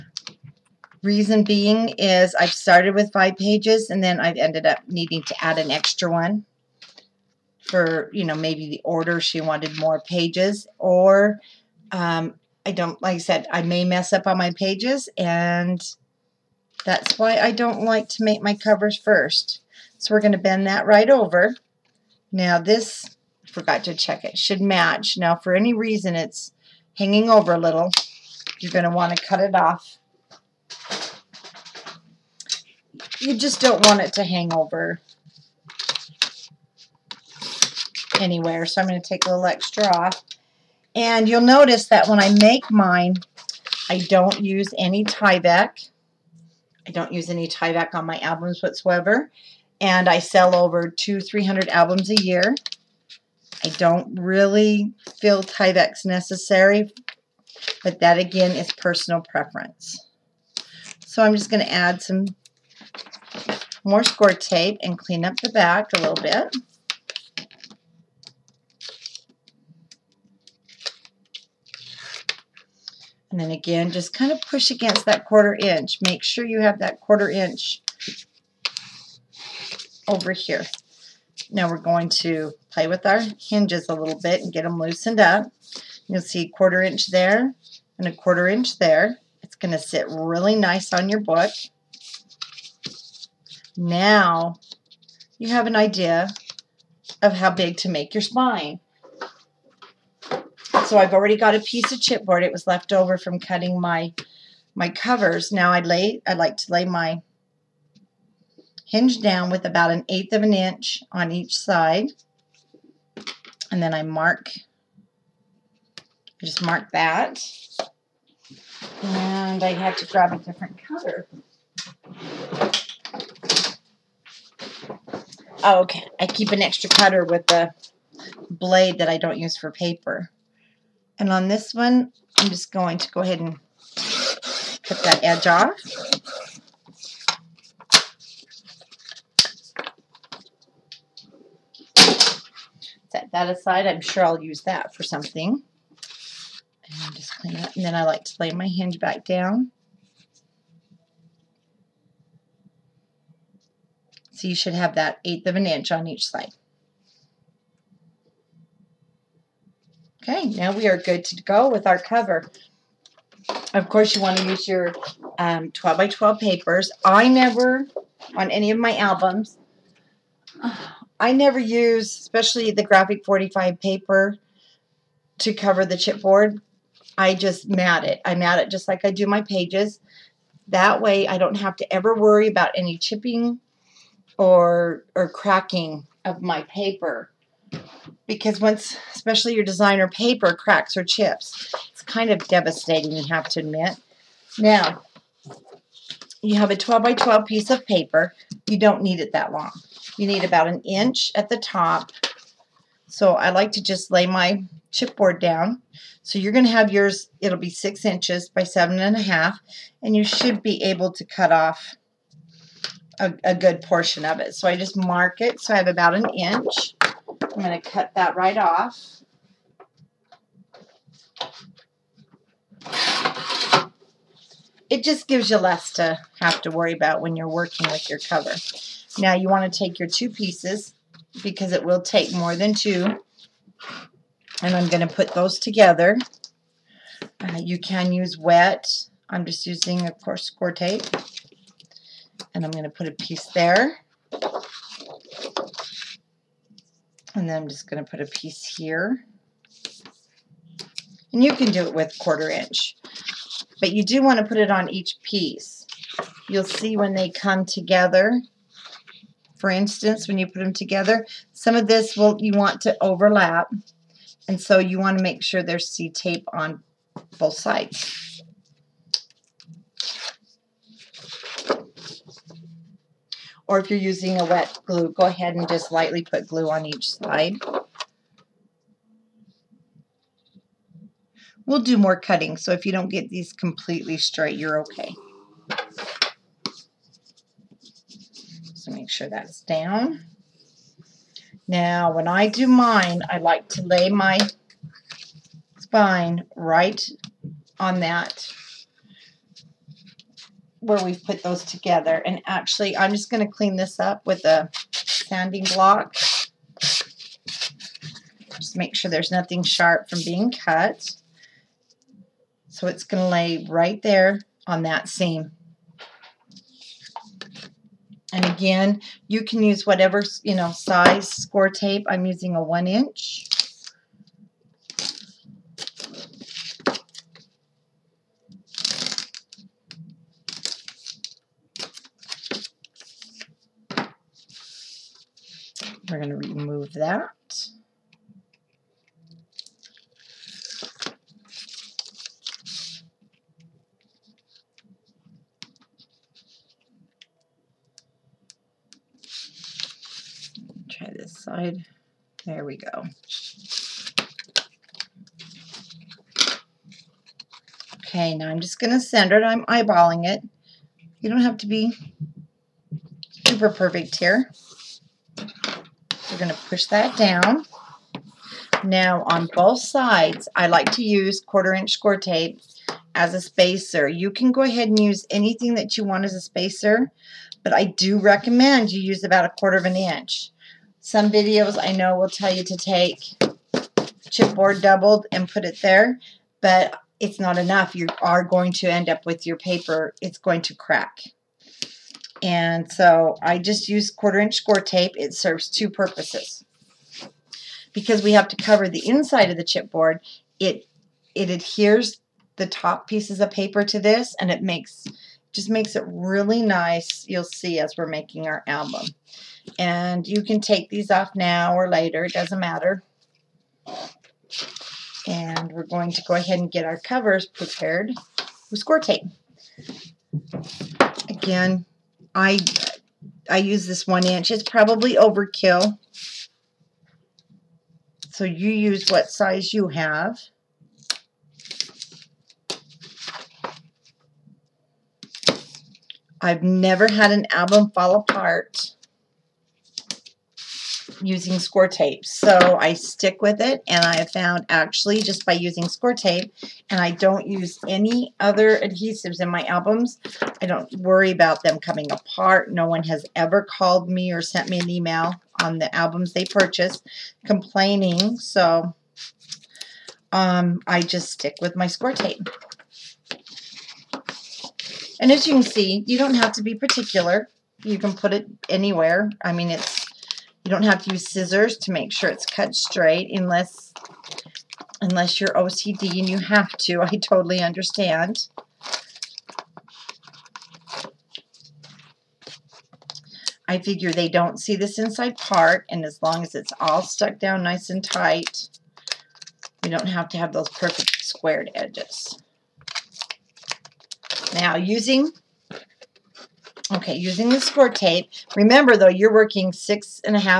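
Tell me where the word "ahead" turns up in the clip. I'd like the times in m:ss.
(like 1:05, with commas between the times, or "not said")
2:13, 4:35, 6:14, 6:56.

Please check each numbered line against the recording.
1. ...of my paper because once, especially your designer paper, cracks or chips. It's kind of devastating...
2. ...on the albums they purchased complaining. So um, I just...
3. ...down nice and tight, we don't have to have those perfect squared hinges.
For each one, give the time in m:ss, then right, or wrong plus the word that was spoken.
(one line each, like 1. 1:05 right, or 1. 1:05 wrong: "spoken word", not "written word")
1. 3:06 right
2. 7:35 right
3. 8:07 wrong: "edges", not "hinges".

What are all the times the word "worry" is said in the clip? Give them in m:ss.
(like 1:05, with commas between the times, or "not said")
3:02, 3:46, 7:30.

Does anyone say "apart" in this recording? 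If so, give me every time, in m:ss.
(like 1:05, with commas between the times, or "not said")
7:18, 7:32.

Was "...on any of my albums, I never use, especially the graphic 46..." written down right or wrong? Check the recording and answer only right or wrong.
wrong.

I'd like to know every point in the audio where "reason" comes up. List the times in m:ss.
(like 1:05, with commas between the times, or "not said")
0:01, 0:25.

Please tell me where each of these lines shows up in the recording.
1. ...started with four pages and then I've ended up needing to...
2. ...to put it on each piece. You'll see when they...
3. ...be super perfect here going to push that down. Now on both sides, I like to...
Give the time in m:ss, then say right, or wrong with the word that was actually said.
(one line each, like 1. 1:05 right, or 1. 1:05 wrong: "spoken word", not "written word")
1. 0:02 wrong: "five", not "four"
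2. 4:14 right
3. 6:01 right.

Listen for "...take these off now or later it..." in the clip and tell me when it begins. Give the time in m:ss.
6:50.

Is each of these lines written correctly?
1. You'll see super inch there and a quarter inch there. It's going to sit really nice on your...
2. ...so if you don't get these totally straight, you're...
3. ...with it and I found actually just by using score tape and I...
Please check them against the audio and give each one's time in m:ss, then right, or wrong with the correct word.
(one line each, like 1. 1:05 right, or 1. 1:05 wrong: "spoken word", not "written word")
1. 1:26 wrong: "quarter", not "super"
2. 4:42 wrong: "completely", not "totally"
3. 7:23 right.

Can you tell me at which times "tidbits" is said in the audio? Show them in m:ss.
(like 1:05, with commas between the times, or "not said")
not said.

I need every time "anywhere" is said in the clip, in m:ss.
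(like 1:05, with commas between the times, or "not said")
0:38, 7:48.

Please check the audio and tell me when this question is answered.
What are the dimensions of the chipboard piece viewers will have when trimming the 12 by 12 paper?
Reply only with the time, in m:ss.
3:27.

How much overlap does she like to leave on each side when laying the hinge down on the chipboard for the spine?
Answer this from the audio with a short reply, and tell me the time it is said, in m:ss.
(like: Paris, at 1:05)
1/8 inch, at 1:49.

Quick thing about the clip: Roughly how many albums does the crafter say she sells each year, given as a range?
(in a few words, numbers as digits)
200-300.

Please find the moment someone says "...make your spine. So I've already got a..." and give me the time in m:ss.
1:37.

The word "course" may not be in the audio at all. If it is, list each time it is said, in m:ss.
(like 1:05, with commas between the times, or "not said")
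2:43, 4:00.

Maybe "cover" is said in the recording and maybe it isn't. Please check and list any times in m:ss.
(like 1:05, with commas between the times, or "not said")
0:18, 1:44, 2:00, 2:41, 2:55, 3:48, 6:38, 6:56.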